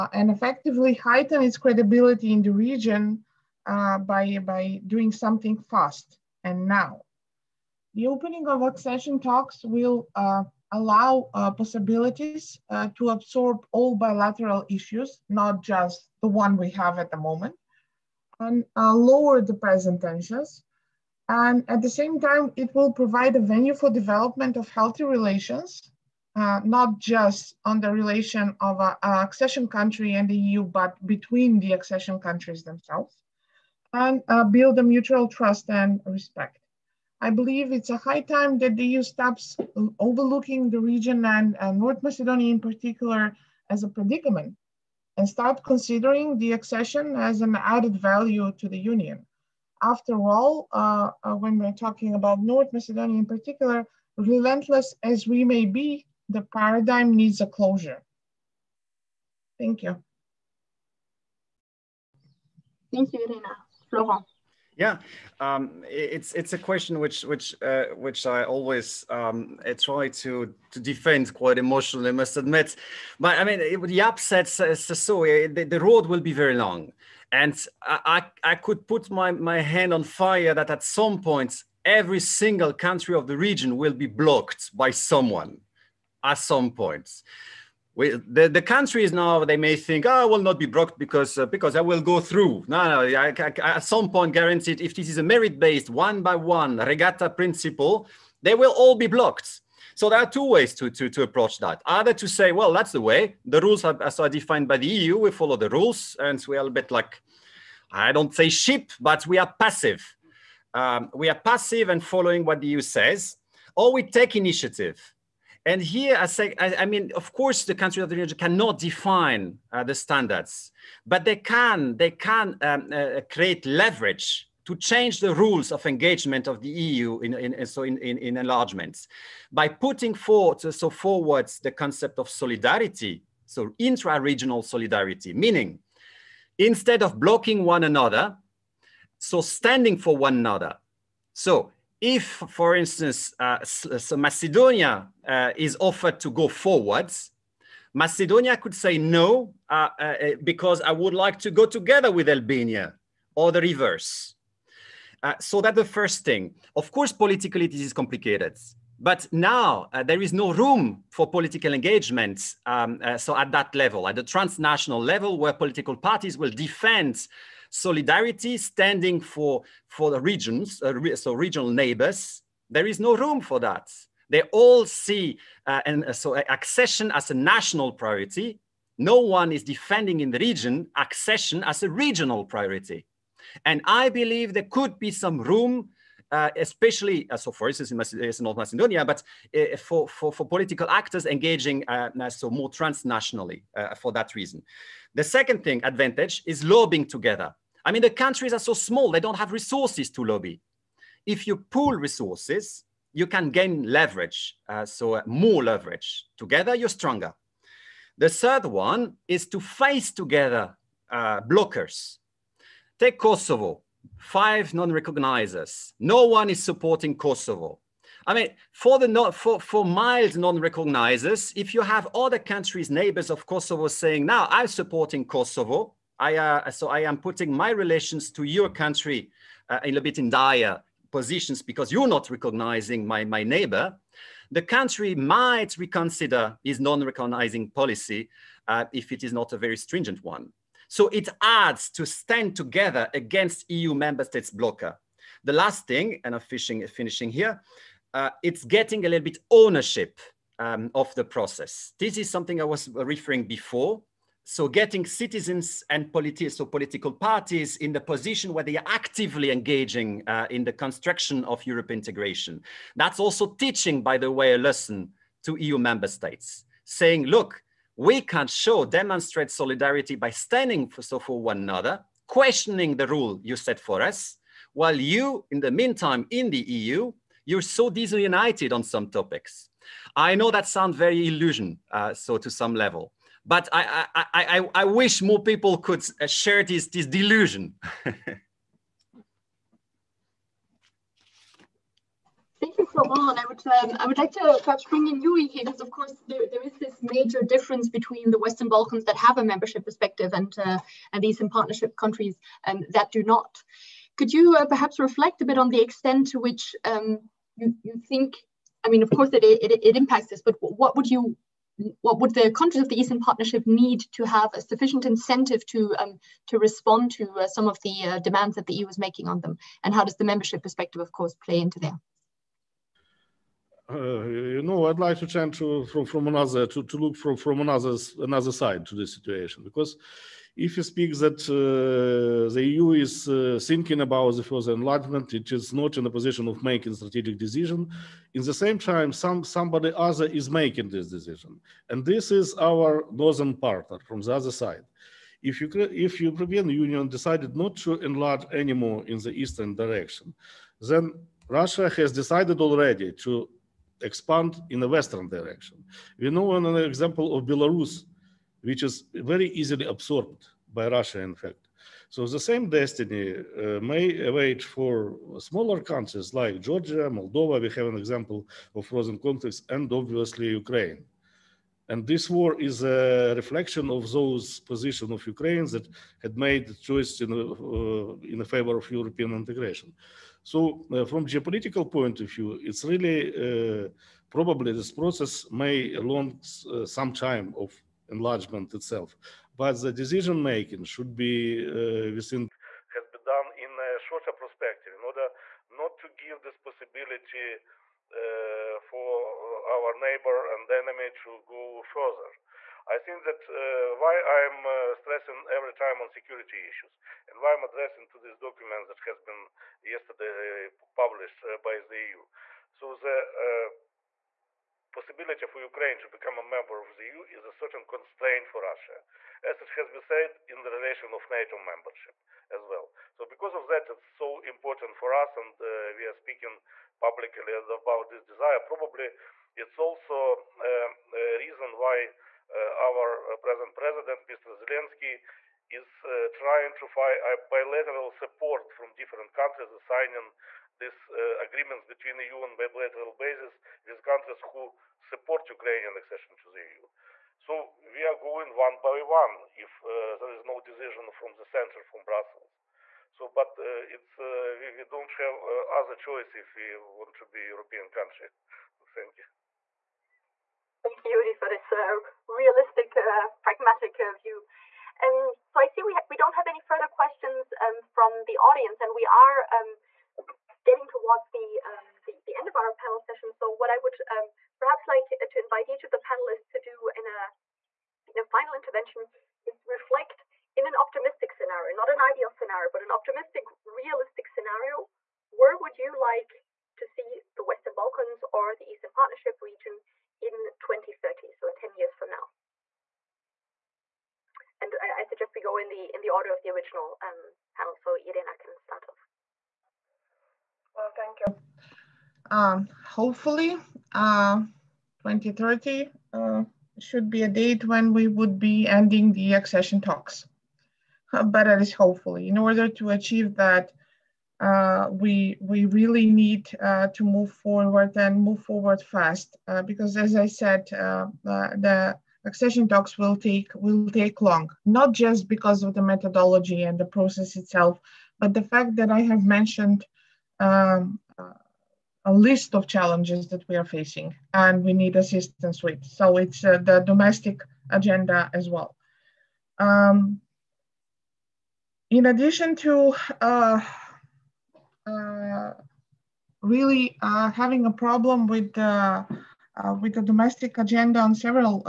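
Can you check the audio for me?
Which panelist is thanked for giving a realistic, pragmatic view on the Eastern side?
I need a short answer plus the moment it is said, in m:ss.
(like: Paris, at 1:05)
Yuri, at 7:41.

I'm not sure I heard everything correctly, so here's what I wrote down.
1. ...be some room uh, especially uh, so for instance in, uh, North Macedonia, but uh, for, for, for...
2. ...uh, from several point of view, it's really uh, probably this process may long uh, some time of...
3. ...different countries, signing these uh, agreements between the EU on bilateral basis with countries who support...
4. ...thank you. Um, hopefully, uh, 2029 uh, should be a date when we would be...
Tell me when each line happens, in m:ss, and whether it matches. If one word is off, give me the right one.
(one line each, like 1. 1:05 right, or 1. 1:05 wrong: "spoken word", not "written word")
1. 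3:04 right
2. 6:20 wrong: "geopolitical", not "several"
3. 7:18 right
4. 8:20 wrong: "2030", not "2029".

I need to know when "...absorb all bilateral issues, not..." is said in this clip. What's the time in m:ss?
0:13.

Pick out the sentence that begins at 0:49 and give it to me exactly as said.
After all, uh, uh, when we're talking about North Macedonia in particular, relentless as we may be, the paradigm needs a closure.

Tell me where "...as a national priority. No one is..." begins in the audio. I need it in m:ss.
2:57.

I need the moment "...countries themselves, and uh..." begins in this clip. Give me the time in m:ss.
0:32.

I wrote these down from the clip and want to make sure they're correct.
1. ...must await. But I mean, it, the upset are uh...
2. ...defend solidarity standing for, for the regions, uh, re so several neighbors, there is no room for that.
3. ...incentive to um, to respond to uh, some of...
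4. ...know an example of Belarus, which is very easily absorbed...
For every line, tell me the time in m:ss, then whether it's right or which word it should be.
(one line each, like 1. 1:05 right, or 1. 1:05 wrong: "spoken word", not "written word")
1. 1:12 wrong: "admit", not "await"
2. 2:46 wrong: "regional", not "several"
3. 5:15 right
4. 5:56 right.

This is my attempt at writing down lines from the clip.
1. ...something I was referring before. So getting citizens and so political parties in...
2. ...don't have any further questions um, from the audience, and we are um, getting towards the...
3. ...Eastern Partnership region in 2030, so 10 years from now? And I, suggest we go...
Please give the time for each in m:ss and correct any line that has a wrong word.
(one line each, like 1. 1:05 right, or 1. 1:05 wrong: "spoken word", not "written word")
1. 4:12 right
2. 7:46 right
3. 8:08 right.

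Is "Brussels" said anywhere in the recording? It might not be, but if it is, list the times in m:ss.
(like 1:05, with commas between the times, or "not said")
7:32.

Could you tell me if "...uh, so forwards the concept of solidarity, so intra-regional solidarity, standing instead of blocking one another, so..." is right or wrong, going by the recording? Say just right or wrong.
wrong.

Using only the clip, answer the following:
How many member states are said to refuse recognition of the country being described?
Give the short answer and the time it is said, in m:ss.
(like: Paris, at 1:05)
5, at 3:34.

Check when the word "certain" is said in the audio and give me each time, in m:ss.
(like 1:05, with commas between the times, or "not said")
6:57.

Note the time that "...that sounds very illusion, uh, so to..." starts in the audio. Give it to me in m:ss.
4:40.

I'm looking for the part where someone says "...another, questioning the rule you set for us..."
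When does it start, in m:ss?
4:31.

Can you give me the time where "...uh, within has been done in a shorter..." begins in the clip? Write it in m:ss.
6:31.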